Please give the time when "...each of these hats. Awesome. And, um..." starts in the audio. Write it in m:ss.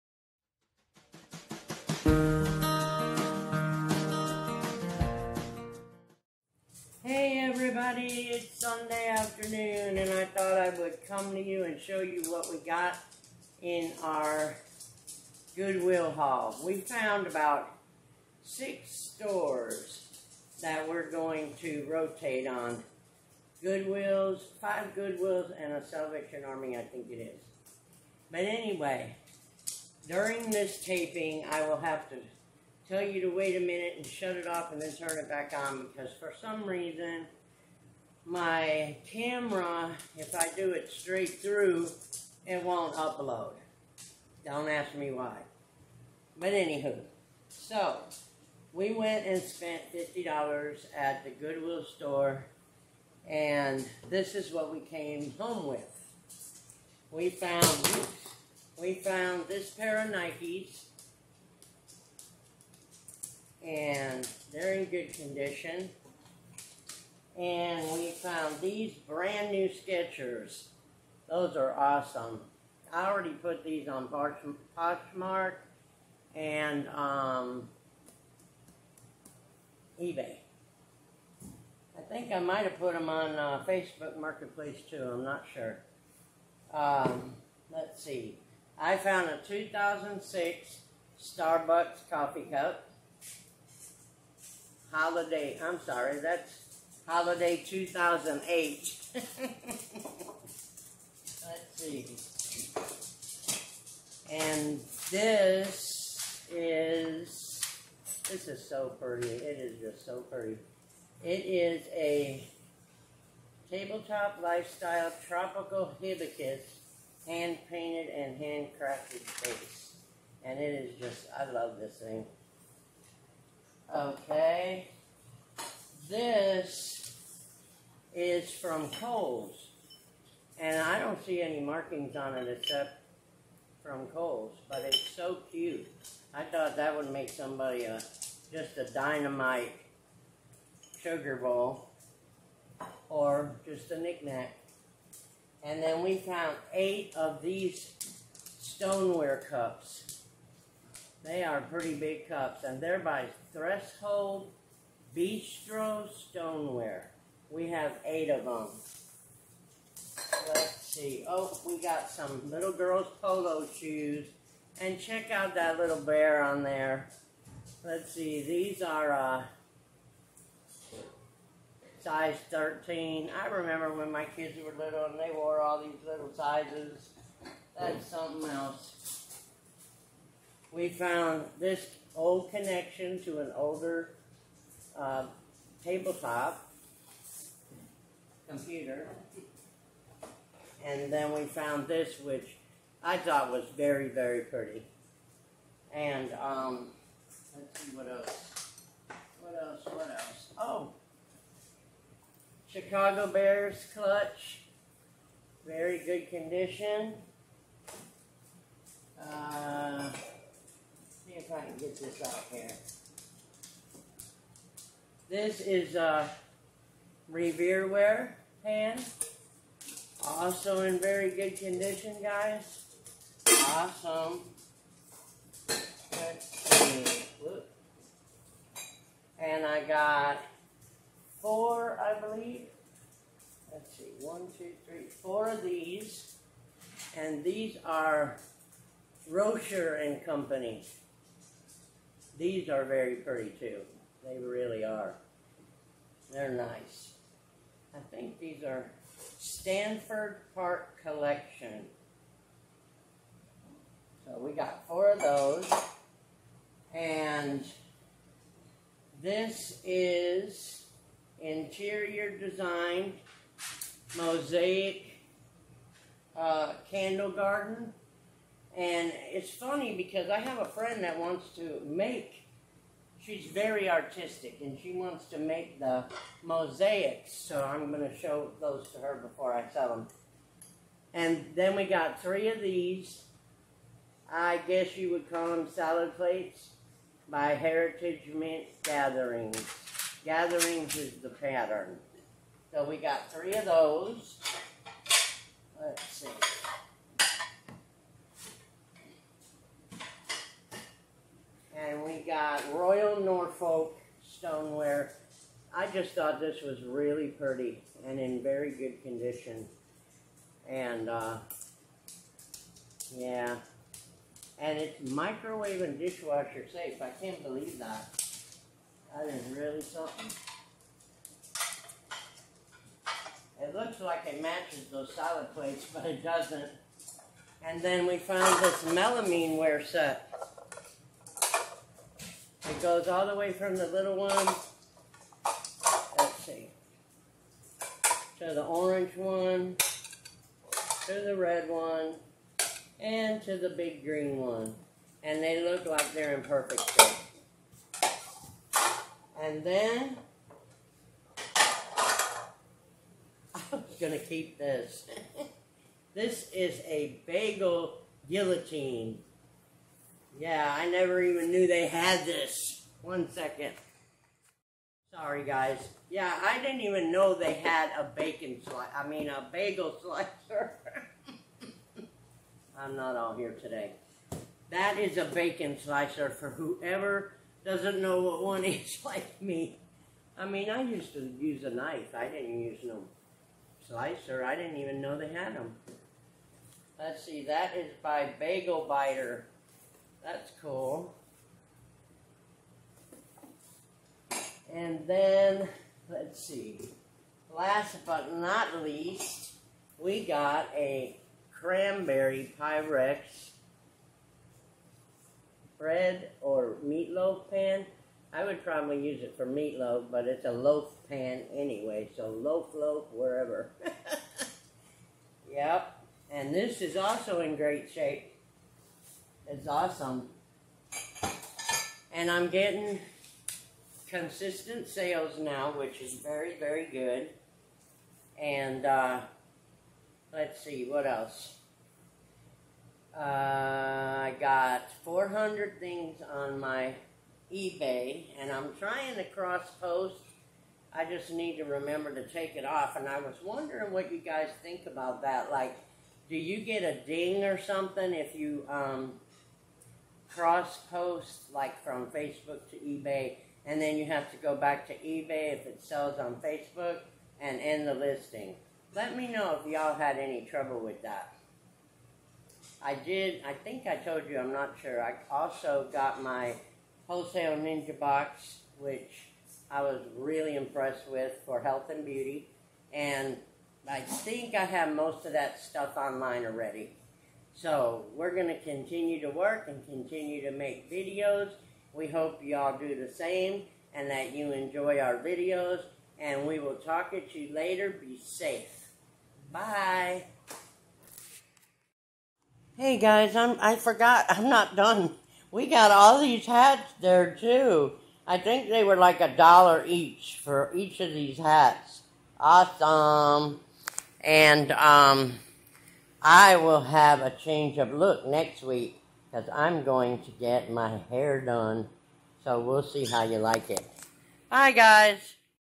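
8:20.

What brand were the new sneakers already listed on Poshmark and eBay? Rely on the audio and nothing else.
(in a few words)
Skechers.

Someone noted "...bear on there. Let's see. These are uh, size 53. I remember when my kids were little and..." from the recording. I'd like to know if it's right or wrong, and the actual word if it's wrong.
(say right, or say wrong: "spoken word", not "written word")
wrong: "13", not "53".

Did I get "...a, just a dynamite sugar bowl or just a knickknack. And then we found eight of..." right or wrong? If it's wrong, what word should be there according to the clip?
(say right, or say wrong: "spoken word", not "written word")
right.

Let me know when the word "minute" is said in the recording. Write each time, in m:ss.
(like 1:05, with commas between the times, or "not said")
0:33.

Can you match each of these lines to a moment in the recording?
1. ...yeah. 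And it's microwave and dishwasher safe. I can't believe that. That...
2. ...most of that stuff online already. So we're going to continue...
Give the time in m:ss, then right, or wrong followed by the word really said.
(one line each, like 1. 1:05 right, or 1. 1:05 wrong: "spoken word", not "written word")
1. 5:13 right
2. 7:54 right.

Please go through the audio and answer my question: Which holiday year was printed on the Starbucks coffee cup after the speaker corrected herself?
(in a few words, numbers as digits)
2008.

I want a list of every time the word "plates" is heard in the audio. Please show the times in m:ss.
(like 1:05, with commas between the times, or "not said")
4:46, 5:25.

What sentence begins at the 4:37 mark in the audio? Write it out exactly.
So I'm going to show those to her before I sell them.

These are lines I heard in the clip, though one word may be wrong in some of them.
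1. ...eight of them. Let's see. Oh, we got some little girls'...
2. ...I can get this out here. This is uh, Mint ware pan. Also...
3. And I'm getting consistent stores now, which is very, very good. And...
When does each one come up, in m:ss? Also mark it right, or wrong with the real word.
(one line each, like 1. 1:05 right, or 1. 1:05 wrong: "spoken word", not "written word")
1. 2:38 right
2. 3:31 wrong: "Revere", not "Mint"
3. 7:02 wrong: "sales", not "stores".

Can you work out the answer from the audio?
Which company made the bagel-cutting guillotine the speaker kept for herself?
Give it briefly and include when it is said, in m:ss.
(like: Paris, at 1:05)
Bagel Biter, at 6:28.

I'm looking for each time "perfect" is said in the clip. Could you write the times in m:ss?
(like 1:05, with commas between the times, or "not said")
5:46.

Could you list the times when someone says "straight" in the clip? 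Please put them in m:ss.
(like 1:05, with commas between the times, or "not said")
0:40.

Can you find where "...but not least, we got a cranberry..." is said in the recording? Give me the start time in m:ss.
6:38.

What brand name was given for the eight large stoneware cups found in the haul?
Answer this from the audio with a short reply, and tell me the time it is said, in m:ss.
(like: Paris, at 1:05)
Threshold Bistro Stoneware, at 2:33.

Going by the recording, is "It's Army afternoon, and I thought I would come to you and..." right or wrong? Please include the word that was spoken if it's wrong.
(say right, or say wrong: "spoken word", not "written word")
wrong: "Sunday", not "Army".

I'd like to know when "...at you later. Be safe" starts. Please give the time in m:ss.
8:07.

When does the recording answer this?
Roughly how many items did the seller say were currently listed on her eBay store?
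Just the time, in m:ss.
7:15.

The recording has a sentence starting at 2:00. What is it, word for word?
And it is just, I love this thing.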